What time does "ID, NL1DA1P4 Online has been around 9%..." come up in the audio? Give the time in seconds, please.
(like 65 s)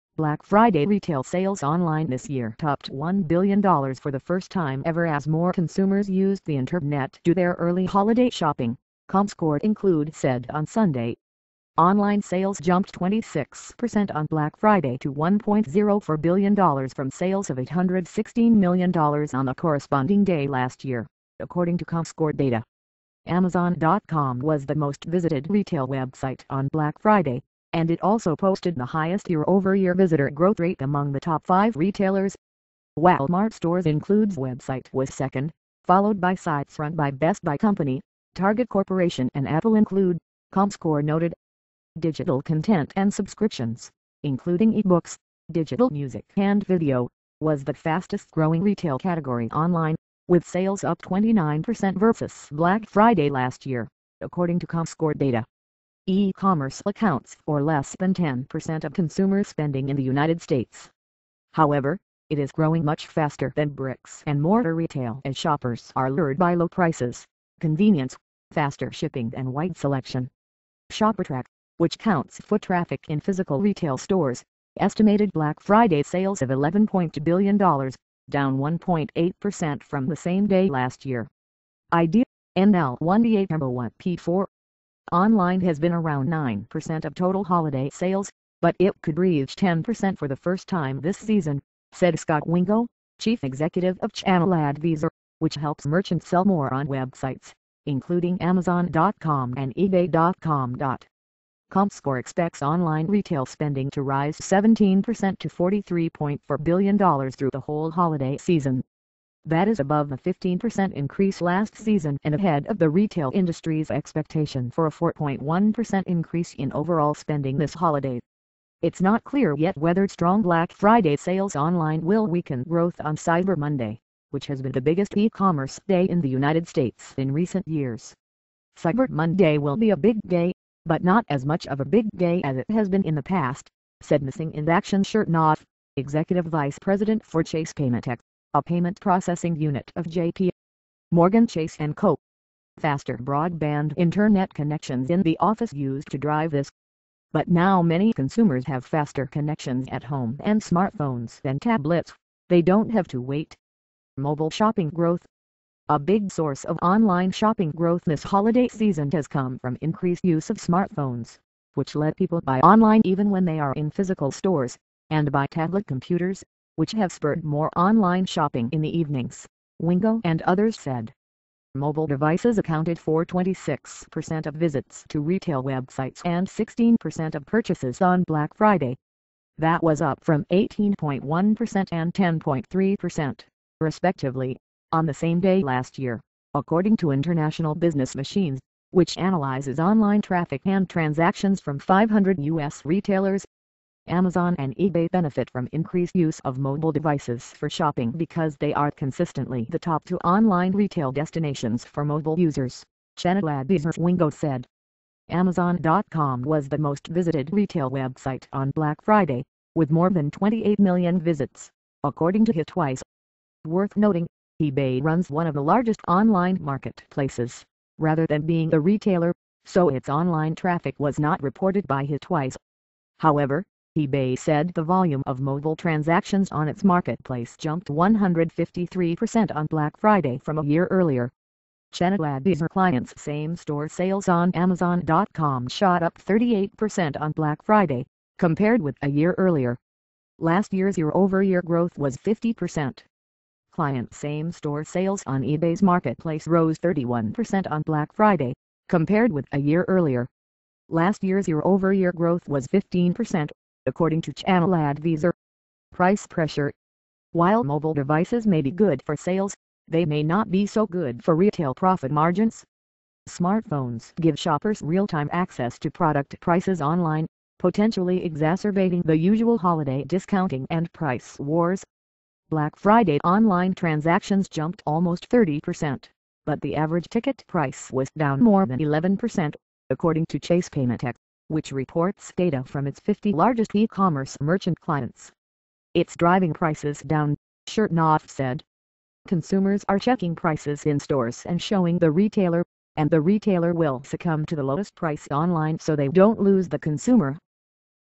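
81 s.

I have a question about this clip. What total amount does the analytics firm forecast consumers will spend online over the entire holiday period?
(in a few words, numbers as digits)
$43.4 billion.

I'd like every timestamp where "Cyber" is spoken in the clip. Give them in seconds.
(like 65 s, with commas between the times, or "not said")
123 s, 128 s.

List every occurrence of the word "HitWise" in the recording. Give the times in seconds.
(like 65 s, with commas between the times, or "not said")
212 s, 222 s.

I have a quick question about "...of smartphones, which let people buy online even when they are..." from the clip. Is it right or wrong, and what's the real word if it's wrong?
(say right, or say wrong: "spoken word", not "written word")
right.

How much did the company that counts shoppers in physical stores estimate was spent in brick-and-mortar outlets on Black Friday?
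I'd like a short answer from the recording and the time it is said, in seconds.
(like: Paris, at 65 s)
$11.2 billion, at 76 s.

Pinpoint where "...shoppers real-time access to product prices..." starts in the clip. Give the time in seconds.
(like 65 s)
264 s.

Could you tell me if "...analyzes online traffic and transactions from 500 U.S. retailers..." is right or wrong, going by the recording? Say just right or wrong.
right.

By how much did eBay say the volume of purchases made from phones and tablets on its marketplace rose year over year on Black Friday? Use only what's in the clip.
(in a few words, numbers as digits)
153%.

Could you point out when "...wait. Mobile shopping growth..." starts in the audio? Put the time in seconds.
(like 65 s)
153 s.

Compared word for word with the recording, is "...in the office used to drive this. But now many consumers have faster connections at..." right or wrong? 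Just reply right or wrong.
right.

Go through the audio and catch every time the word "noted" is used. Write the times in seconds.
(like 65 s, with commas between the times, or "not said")
41 s.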